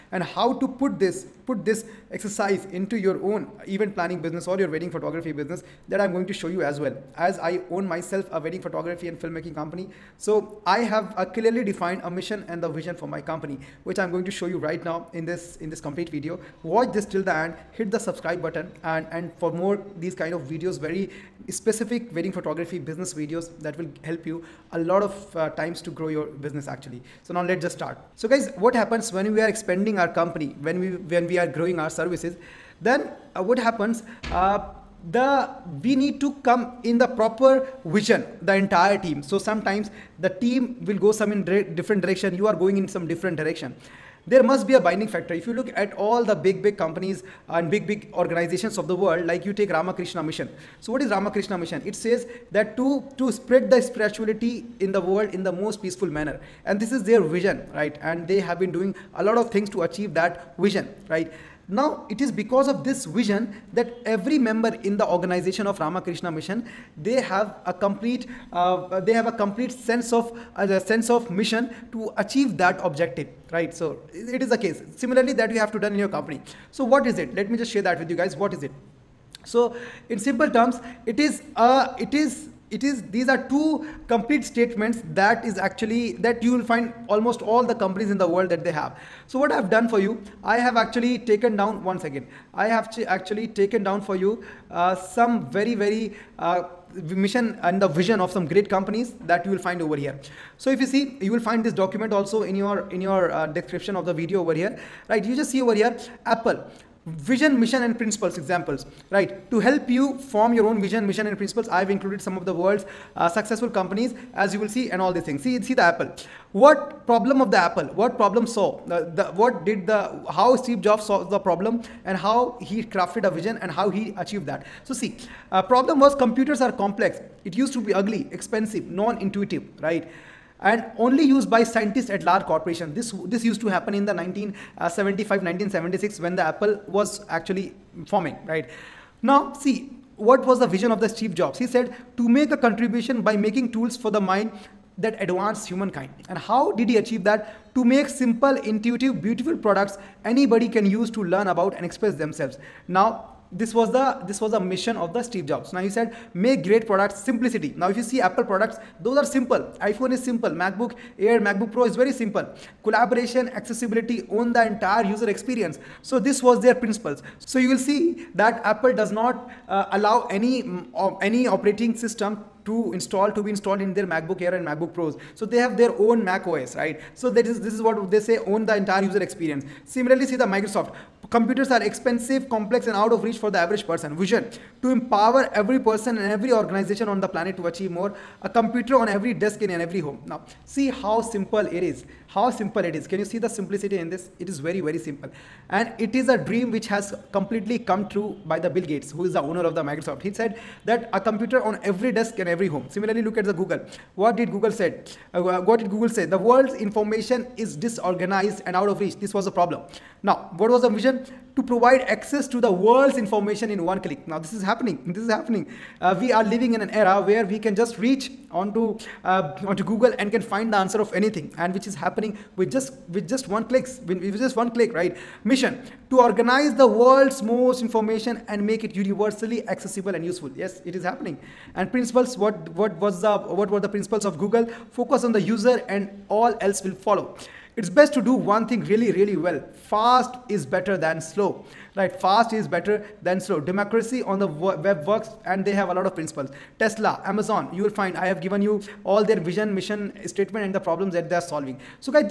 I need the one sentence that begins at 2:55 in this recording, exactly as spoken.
So they have their own Mac OS, right?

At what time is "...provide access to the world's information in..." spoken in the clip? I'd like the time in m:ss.
3:31.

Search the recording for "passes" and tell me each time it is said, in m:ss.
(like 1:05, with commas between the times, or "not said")
not said.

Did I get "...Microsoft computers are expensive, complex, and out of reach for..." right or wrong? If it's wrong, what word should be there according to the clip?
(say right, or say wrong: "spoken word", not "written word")
right.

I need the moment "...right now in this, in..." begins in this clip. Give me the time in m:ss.
0:14.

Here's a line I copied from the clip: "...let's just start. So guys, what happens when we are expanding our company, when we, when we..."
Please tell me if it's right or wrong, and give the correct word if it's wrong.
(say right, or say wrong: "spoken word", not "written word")
right.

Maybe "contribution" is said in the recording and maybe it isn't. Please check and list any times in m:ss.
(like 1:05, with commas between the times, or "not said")
2:22.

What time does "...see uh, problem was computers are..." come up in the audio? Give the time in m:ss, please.
2:04.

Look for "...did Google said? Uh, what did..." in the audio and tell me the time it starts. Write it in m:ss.
3:24.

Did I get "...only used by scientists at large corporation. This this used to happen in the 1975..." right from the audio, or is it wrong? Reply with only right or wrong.
right.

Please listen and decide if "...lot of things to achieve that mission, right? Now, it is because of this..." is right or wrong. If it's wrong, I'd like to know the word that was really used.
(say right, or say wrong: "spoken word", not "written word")
wrong: "vision", not "mission".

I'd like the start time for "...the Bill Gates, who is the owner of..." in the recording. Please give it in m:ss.
3:18.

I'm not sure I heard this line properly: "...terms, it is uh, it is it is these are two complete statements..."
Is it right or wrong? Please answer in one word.
right.